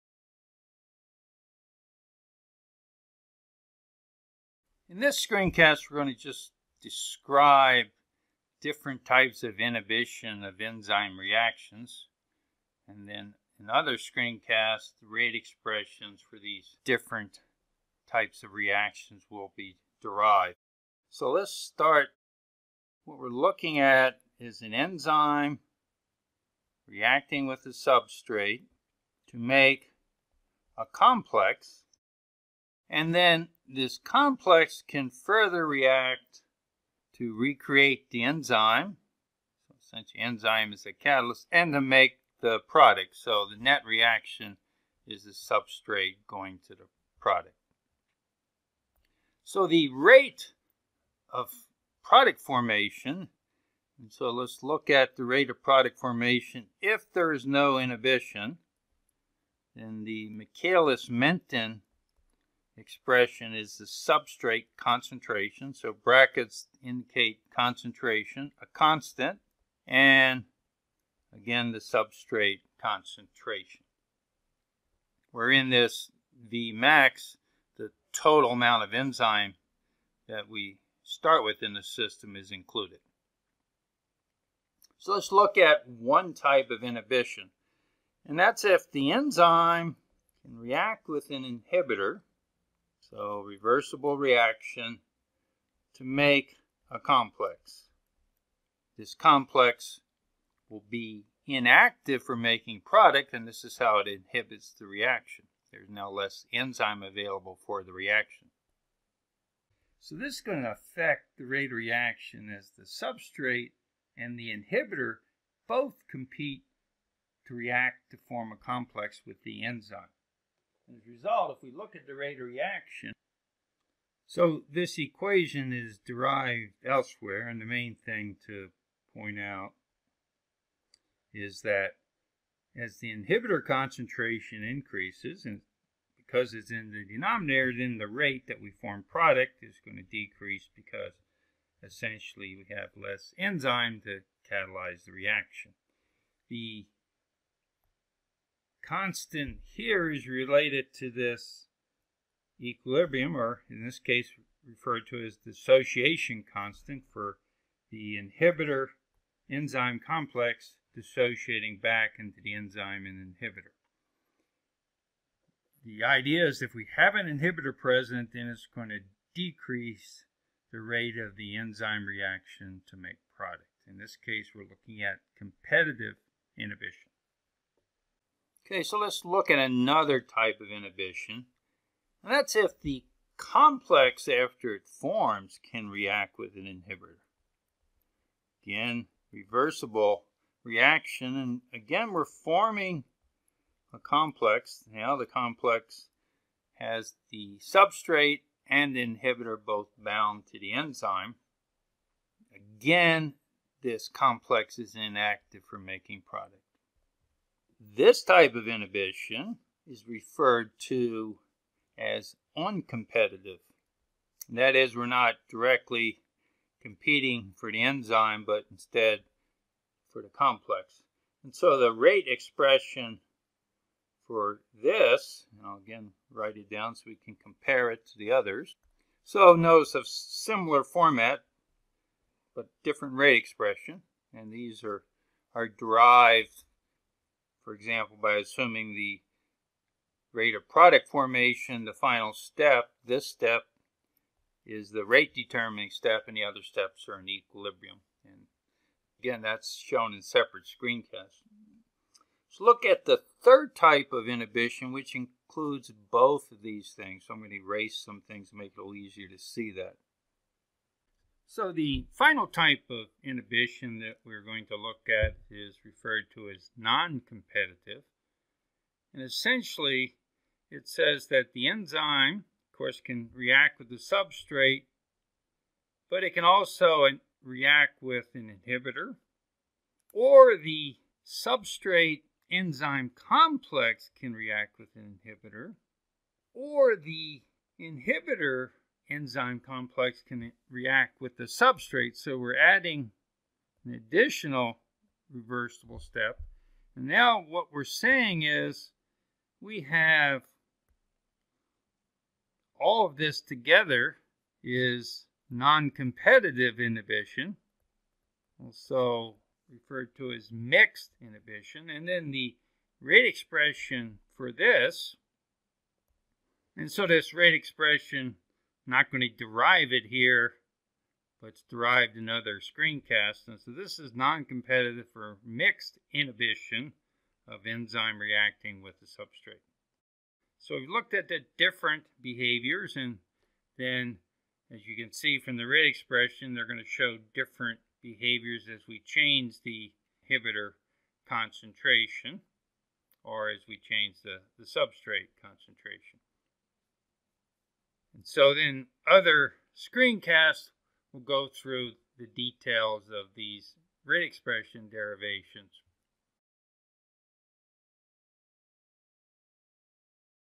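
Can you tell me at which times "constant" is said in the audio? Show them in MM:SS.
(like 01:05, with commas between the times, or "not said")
01:08, 02:28, 02:36.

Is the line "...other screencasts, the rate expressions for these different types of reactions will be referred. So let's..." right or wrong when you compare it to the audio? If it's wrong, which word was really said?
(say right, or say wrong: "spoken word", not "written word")
wrong: "derived", not "referred".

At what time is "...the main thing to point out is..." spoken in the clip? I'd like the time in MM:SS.
02:07.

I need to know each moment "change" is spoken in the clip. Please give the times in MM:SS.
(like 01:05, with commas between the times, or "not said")
05:39, 05:43.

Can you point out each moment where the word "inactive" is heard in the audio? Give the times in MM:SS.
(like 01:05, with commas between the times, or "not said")
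01:41, 03:24.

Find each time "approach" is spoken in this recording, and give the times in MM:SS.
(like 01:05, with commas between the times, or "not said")
not said.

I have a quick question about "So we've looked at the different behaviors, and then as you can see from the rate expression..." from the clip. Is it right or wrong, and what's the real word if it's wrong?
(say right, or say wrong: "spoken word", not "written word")
right.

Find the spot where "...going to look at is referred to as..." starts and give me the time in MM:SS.
04:24.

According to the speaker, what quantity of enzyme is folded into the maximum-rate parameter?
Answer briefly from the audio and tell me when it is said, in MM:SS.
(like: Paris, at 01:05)
total amount of enzyme, at 01:17.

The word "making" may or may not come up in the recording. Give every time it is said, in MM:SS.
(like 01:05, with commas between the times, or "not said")
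01:42, 03:25.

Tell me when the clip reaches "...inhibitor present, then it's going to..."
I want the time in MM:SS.
02:47.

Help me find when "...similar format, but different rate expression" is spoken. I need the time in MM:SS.
03:50.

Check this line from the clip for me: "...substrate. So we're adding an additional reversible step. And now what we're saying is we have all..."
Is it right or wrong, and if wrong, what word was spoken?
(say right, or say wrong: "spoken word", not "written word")
right.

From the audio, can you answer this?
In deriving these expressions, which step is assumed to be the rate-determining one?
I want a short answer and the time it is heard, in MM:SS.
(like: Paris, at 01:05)
the final step, at 04:01.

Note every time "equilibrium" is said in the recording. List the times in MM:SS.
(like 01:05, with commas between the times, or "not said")
02:32, 04:07.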